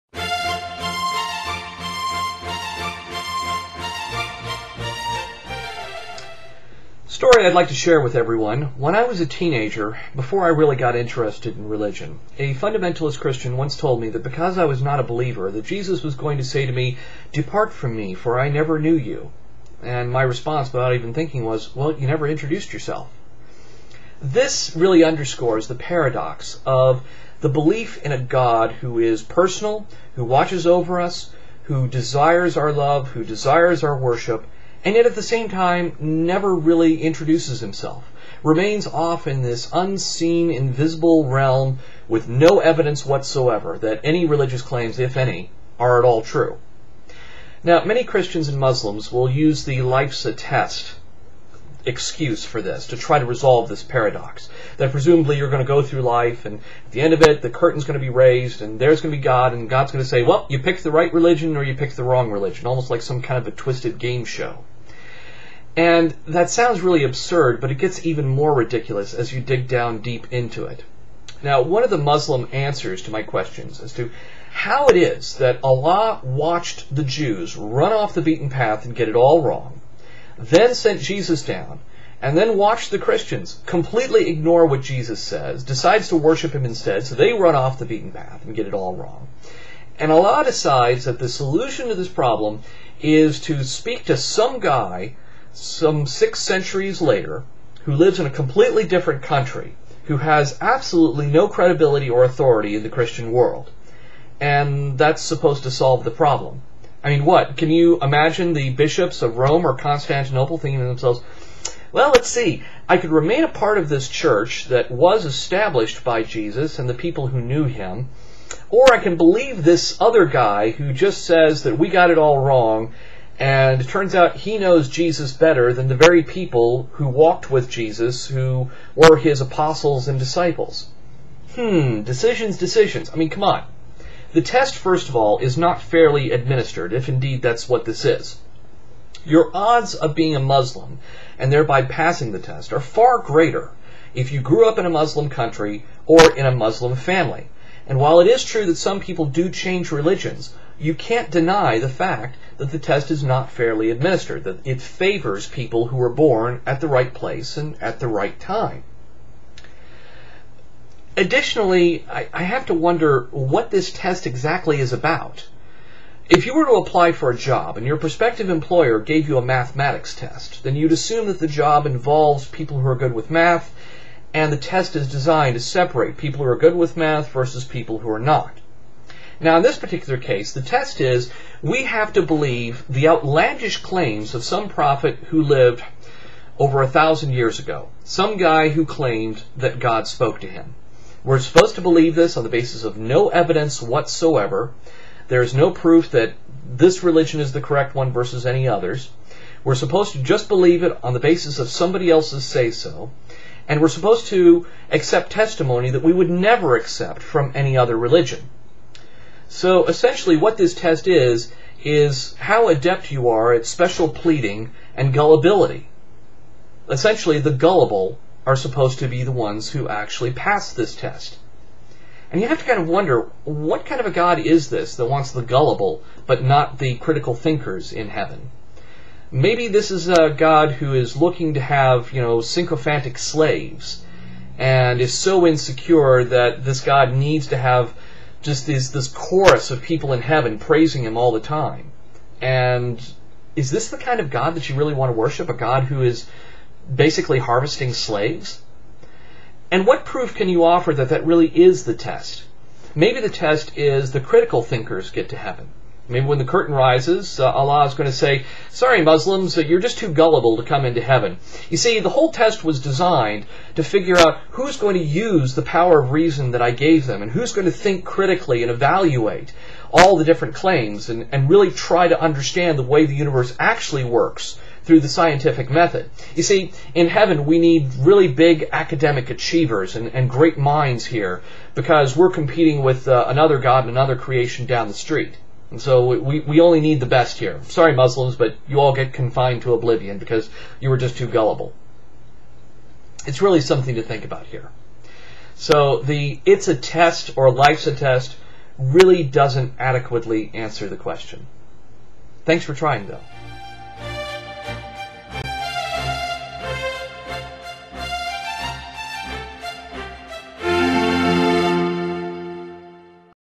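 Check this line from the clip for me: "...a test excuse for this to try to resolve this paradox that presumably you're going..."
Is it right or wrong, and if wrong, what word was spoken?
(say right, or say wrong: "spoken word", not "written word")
right.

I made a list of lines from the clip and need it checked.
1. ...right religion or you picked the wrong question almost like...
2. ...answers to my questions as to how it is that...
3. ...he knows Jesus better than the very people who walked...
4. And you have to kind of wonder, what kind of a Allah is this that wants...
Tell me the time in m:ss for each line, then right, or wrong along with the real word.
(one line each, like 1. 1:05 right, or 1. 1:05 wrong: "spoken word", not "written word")
1. 1:00 wrong: "religion", not "question"
2. 1:12 right
3. 2:04 right
4. 3:42 wrong: "God", not "Allah".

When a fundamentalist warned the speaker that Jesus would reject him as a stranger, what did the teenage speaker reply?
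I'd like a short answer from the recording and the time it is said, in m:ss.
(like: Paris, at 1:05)
You never introduced yourself, at 0:21.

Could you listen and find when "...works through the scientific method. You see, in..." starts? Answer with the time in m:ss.
4:34.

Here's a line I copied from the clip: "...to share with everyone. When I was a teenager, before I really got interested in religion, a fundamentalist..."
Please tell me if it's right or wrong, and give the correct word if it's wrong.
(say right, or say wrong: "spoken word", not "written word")
right.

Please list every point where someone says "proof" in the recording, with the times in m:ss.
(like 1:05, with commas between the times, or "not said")
3:15, 4:10.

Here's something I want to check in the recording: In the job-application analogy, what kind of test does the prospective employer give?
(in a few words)
Mathematics test.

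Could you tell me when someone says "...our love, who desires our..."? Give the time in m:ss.
0:32.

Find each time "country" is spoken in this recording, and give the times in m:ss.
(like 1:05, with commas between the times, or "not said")
1:39, 2:25.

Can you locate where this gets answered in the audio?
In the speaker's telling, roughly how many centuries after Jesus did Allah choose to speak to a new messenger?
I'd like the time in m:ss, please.
1:36.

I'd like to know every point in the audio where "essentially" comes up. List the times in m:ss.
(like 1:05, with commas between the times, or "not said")
3:29, 3:36.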